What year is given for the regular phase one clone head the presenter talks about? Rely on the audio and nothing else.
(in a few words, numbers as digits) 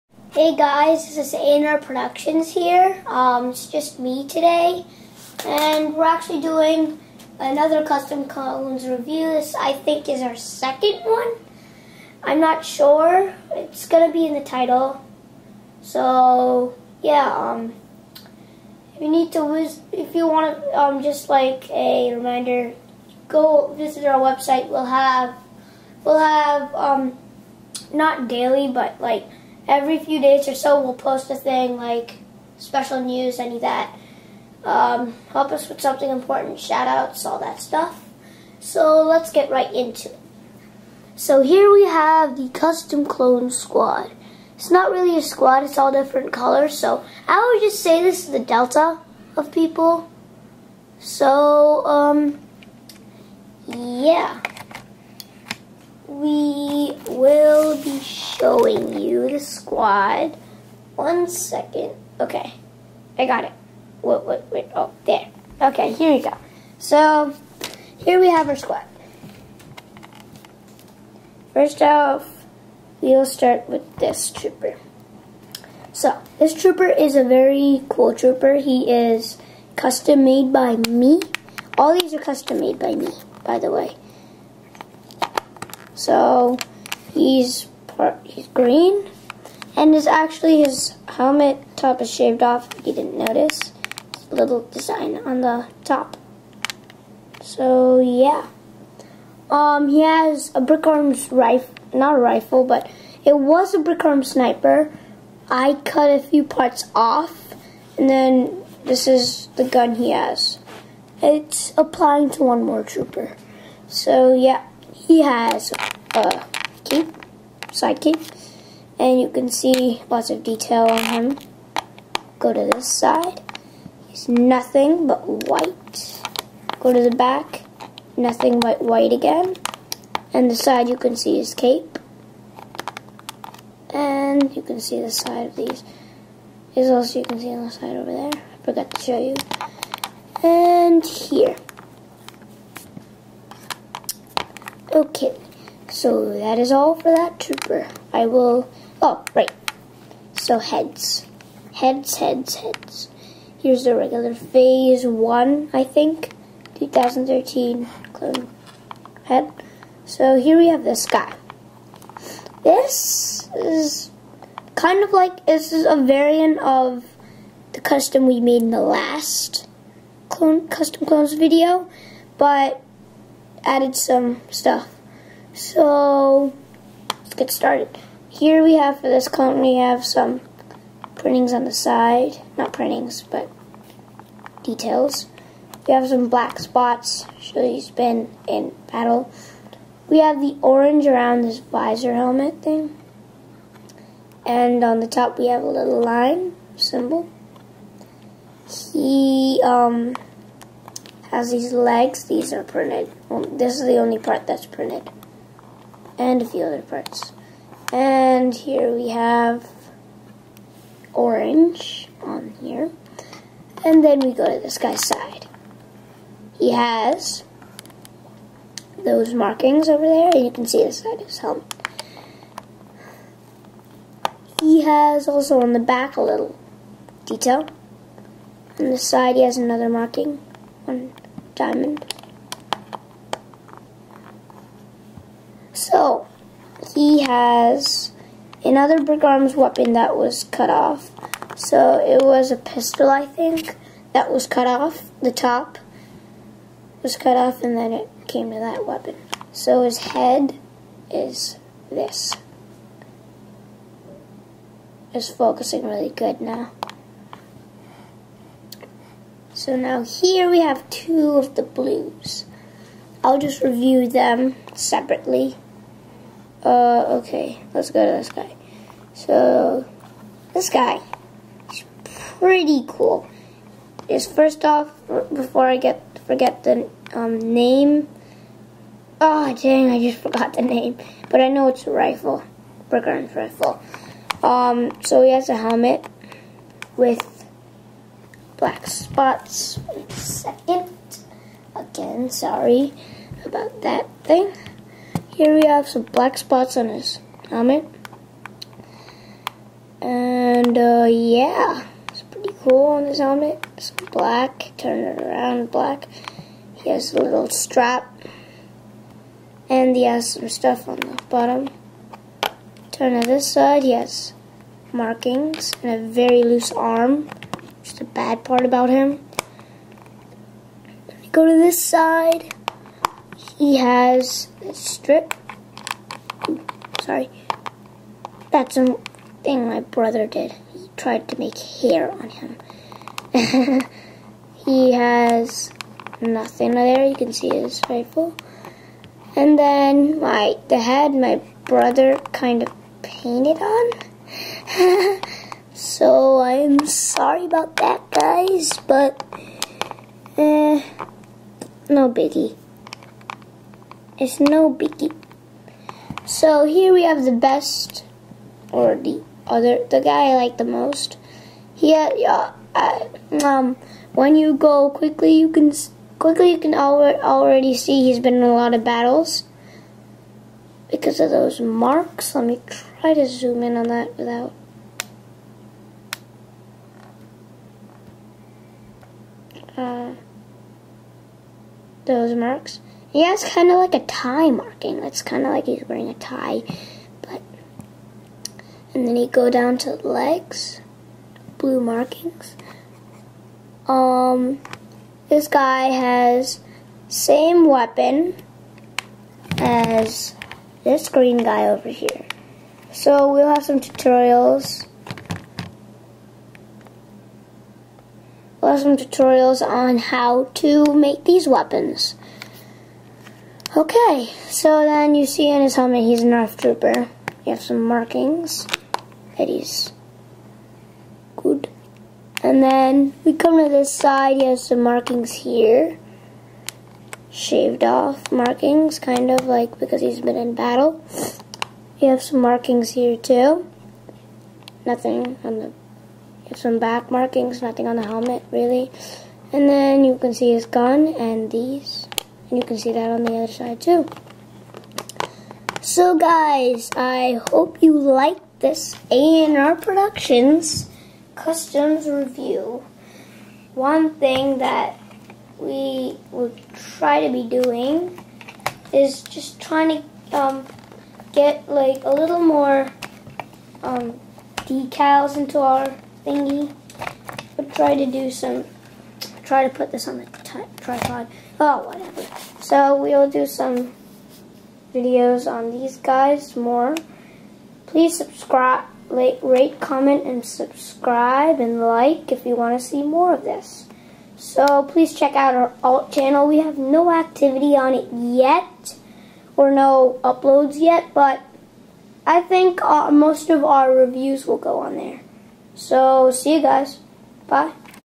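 2013.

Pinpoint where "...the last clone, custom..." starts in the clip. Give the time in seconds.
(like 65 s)
168 s.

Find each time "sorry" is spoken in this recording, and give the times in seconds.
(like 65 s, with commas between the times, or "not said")
292 s, 327 s, 346 s.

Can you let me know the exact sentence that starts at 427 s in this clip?
Shaved off markings, kind of like because he's been in battle.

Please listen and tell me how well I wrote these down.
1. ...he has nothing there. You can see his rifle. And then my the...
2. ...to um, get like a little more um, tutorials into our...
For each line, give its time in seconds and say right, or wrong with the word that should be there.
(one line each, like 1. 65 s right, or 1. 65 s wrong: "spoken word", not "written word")
1. 334 s right
2. 460 s wrong: "decals", not "tutorials".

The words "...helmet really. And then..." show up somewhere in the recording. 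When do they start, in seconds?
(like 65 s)
438 s.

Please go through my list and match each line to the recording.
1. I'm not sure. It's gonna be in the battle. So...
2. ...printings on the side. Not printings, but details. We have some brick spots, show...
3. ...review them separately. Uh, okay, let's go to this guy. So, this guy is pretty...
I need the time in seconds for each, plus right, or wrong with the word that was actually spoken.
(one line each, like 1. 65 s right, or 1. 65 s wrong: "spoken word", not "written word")
1. 12 s wrong: "title", not "battle"
2. 181 s wrong: "black", not "brick"
3. 263 s right.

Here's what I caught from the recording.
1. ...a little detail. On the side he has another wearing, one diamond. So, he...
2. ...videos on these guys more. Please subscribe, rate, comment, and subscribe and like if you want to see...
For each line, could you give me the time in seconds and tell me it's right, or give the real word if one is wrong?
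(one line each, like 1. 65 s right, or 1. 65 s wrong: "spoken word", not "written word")
1. 226 s wrong: "marking", not "wearing"
2. 474 s right.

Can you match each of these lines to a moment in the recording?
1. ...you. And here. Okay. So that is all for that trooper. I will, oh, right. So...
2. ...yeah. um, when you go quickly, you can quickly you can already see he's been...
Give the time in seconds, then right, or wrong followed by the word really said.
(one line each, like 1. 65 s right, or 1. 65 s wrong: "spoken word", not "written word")
1. 139 s right
2. 362 s right.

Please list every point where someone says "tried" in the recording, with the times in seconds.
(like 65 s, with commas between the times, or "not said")
330 s.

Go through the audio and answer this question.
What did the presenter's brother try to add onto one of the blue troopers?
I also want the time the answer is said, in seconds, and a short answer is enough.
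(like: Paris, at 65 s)
Hair, at 331 s.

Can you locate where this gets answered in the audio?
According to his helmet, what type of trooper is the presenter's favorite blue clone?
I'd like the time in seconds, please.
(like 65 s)
416 s.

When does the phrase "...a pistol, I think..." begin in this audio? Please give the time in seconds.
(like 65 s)
242 s.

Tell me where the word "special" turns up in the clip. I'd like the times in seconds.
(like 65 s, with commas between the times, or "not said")
32 s.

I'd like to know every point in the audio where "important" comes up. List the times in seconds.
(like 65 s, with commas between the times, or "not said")
36 s.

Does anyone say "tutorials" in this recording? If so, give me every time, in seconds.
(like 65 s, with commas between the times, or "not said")
403 s, 408 s.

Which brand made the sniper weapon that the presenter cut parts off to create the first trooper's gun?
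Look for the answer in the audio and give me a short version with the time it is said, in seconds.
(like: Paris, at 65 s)
BrickArms, at 100 s.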